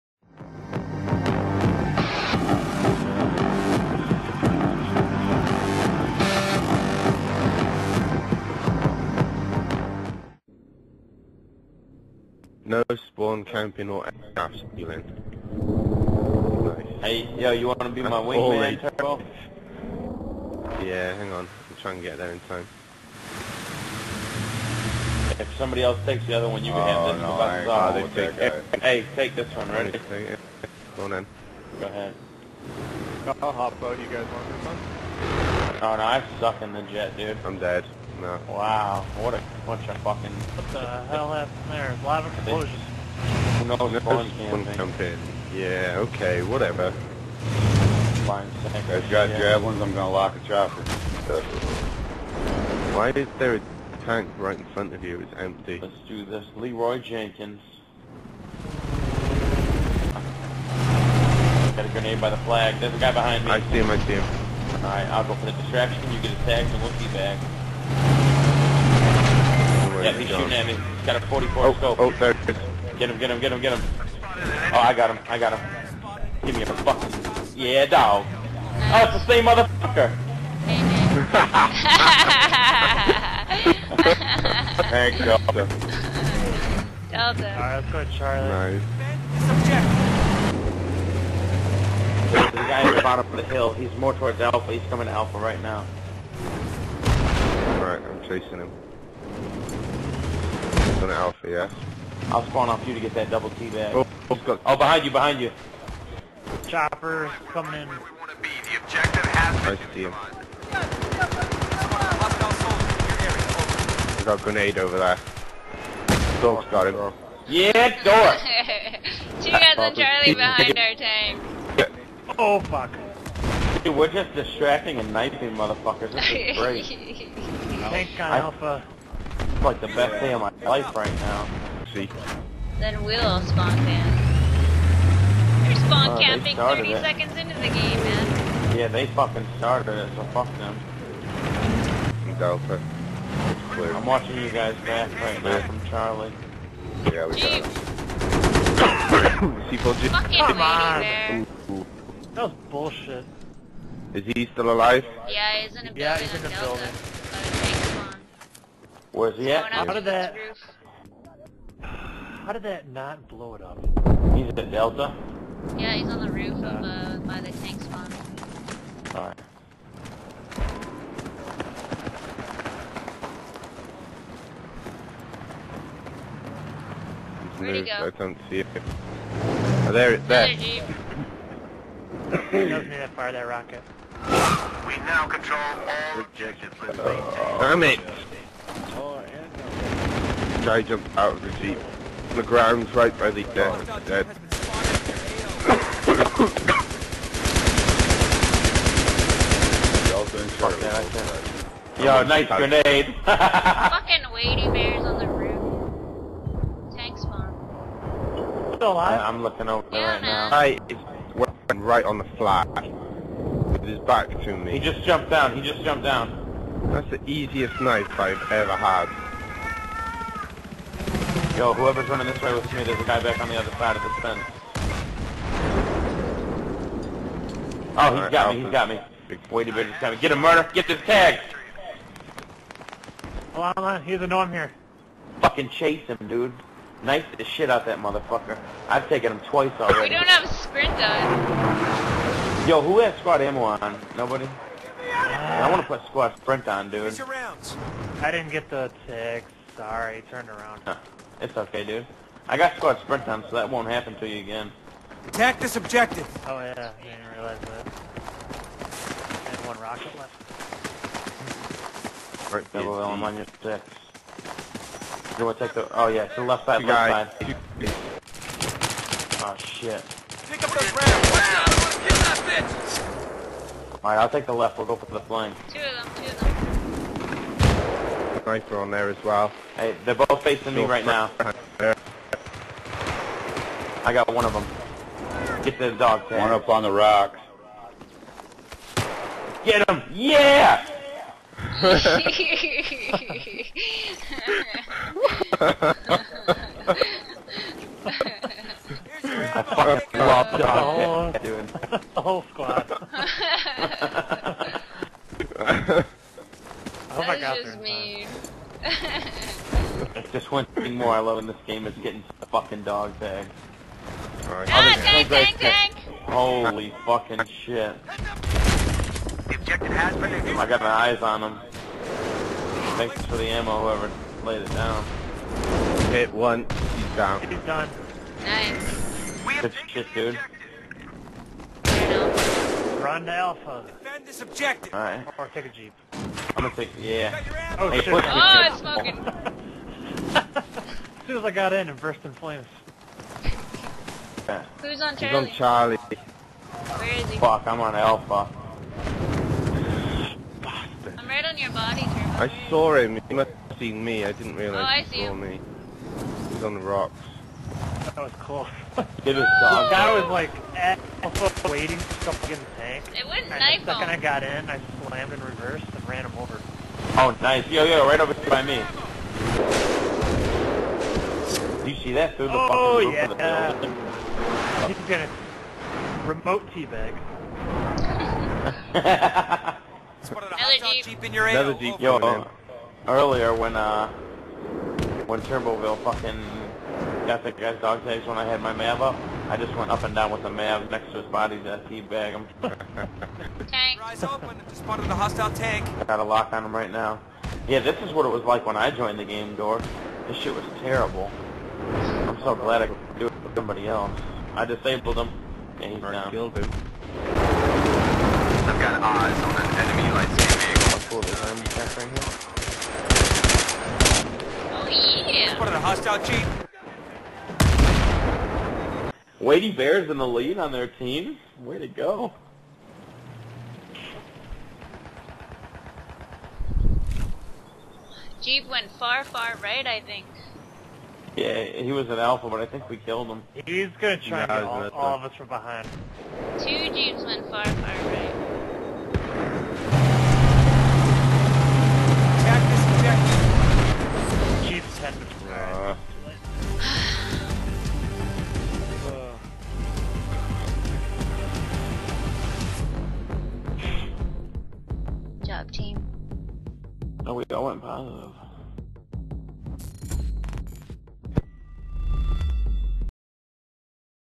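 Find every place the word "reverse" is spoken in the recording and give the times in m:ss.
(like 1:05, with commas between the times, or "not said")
6:05.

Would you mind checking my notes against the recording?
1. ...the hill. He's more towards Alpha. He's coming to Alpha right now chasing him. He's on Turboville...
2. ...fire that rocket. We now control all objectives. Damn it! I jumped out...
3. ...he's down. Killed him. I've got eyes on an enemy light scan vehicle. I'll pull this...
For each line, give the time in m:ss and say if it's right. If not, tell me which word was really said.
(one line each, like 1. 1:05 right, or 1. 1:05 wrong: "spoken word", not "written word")
1. 1:33 wrong: "Alpha", not "Turboville"
2. 3:03 right
3. 6:45 right.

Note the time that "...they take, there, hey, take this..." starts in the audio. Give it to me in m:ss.
0:28.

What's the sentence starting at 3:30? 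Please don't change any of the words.
I is right on the flat.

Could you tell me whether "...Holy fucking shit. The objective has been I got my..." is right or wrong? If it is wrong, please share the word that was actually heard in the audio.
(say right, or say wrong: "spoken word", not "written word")
right.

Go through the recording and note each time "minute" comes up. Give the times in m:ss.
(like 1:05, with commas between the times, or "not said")
3:49.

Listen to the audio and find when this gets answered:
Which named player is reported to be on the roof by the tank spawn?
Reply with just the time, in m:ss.
3:24.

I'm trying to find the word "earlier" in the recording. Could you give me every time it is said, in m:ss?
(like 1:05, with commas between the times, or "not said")
6:23.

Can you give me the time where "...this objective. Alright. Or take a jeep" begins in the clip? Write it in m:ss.
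5:34.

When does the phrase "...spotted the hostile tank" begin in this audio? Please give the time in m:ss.
6:34.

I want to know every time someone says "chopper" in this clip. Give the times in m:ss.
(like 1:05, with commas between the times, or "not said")
0:50, 1:46.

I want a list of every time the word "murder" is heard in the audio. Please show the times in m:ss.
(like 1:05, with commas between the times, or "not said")
3:50.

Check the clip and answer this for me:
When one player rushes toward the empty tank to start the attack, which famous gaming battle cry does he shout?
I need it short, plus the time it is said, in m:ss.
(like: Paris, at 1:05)
Leroy Jenkins, at 0:56.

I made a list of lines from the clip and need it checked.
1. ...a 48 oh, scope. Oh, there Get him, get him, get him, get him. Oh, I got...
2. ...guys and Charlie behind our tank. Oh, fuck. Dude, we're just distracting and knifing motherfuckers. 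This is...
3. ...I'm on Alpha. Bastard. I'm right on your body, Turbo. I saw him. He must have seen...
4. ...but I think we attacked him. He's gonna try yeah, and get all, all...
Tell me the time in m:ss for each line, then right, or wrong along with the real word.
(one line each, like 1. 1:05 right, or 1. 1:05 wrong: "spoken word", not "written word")
1. 1:11 wrong: "44", not "48"
2. 1:59 right
3. 5:47 right
4. 7:12 wrong: "killed", not "attacked".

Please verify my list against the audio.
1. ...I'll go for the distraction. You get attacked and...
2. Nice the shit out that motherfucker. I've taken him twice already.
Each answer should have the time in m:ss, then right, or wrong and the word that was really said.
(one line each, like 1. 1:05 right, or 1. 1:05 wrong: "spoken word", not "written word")
1. 1:05 right
2. 3:57 right.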